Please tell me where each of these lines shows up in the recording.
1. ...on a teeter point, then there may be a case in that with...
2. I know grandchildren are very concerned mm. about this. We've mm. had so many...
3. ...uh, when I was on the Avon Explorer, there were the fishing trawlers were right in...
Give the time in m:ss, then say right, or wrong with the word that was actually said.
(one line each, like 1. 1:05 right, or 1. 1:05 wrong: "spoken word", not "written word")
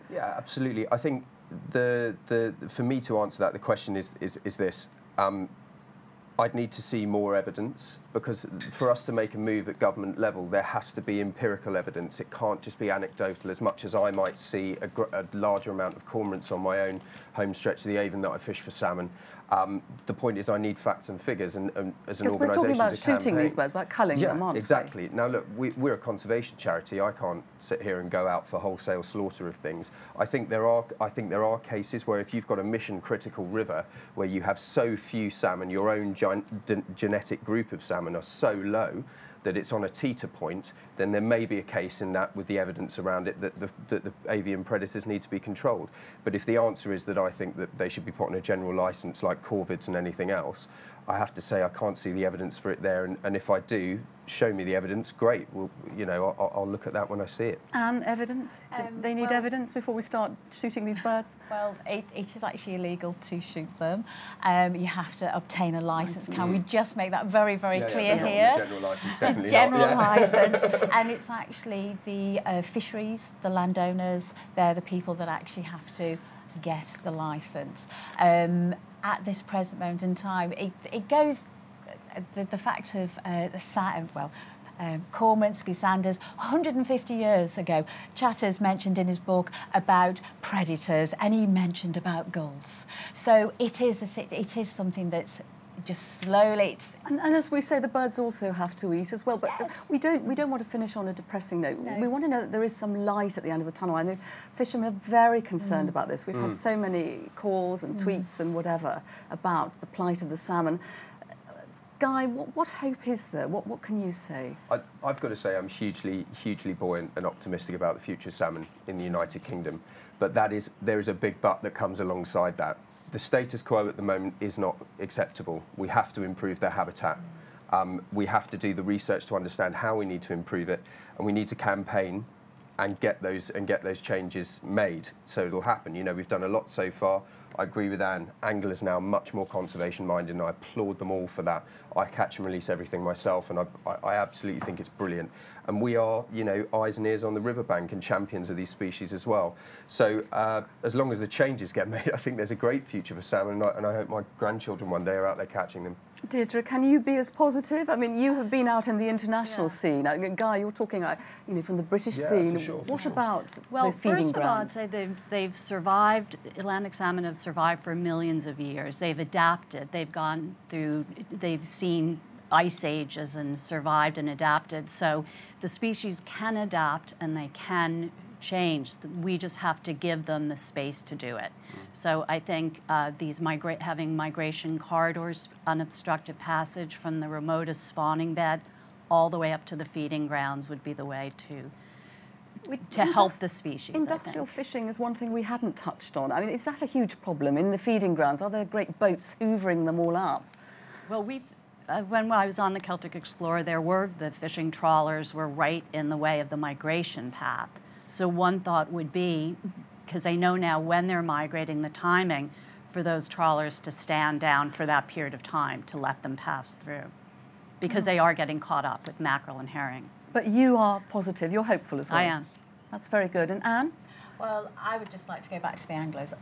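1. 0:39 right
2. 1:43 wrong: "fishermen", not "grandchildren"
3. 3:21 wrong: "Celtic", not "Avon".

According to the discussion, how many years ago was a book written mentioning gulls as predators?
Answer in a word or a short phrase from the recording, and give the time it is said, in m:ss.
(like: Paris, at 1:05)
150, at 1:26.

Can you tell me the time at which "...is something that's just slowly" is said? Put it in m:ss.
1:34.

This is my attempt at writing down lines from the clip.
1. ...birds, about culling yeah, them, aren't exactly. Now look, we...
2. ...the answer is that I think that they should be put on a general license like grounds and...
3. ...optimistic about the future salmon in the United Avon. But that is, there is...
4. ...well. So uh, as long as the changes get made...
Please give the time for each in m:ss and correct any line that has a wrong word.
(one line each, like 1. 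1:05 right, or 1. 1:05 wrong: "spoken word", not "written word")
1. 0:23 right
2. 0:46 wrong: "corvids", not "grounds"
3. 1:57 wrong: "Kingdom", not "Avon"
4. 2:29 right.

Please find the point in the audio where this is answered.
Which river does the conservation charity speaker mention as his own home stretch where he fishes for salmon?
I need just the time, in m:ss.
0:17.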